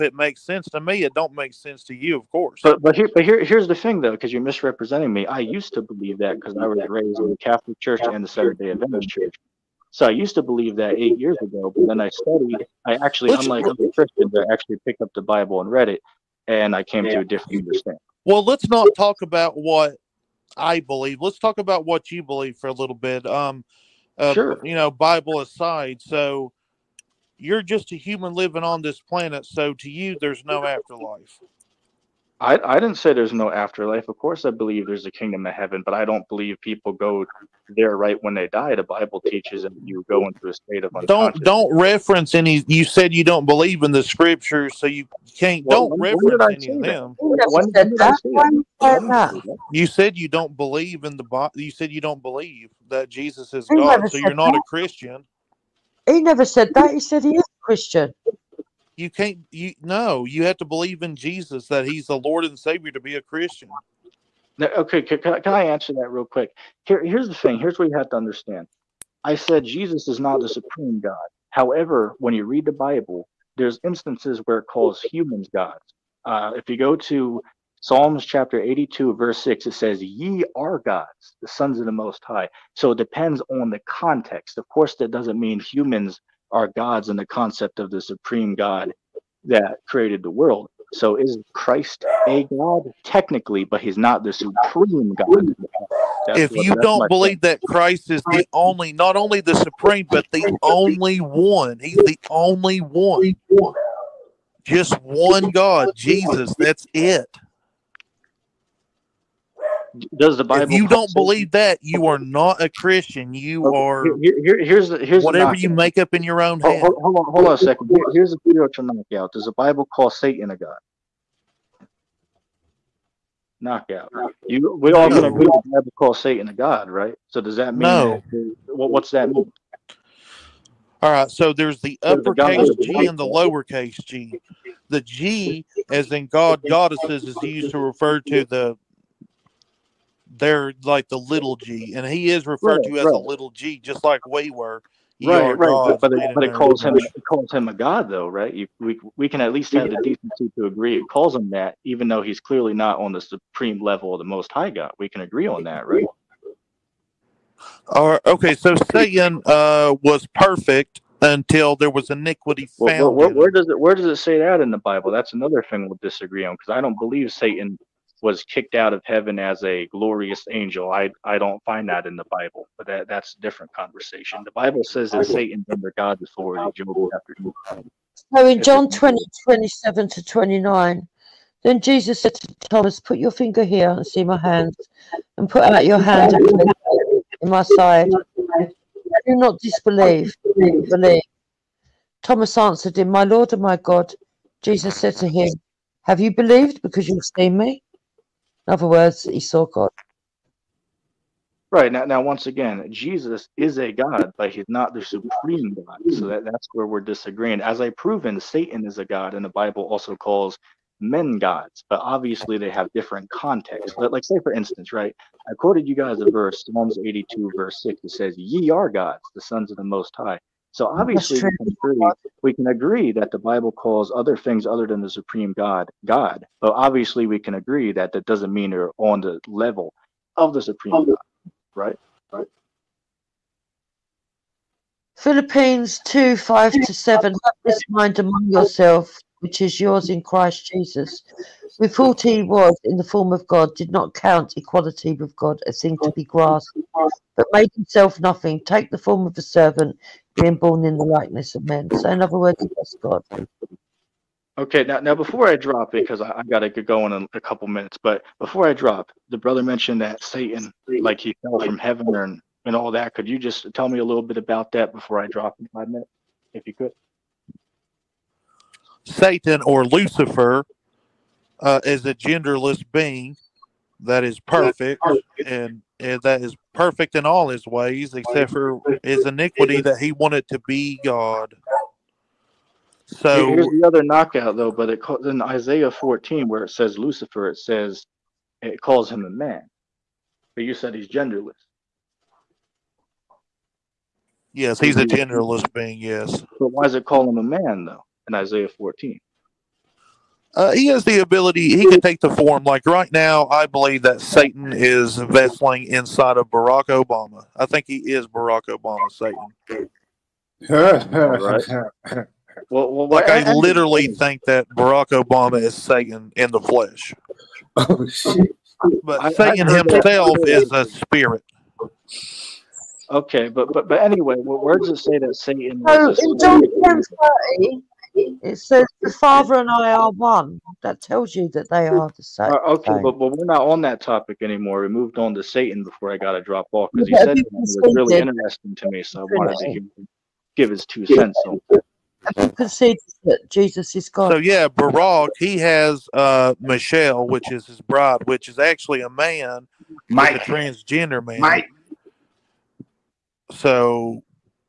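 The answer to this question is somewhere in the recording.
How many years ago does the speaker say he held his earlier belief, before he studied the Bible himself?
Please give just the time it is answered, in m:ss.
0:10.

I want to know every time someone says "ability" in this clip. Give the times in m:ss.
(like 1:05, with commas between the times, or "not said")
5:01.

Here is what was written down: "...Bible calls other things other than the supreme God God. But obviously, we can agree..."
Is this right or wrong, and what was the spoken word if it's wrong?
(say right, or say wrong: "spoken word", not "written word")
right.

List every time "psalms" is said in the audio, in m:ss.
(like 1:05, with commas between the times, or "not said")
1:17, 3:36.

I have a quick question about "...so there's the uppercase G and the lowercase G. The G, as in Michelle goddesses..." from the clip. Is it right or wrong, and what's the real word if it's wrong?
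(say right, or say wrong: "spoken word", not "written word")
wrong: "God", not "Michelle".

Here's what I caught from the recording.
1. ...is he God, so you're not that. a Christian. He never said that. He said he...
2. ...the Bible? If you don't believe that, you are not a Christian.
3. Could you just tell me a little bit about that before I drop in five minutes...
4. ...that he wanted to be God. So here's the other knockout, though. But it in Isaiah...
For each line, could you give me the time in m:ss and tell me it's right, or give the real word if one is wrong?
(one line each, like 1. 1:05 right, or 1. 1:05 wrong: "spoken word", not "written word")
1. 0:53 right
2. 1:50 right
3. 4:23 right
4. 4:39 right.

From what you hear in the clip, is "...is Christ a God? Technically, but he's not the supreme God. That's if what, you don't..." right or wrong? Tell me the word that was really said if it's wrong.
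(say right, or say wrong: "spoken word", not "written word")
right.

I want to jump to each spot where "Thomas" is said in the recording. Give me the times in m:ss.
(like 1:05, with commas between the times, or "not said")
3:02, 3:12.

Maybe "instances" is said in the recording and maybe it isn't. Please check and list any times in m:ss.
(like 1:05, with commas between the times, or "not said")
1:13, 3:34.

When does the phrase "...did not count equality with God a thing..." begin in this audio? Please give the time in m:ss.
4:03.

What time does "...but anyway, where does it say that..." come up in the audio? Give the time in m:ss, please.
5:23.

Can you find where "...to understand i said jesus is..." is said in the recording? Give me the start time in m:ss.
1:08.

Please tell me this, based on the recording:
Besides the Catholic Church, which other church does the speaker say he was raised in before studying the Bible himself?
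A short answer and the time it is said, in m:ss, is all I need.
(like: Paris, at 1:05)
Seventh Day Adventist Church, at 0:08.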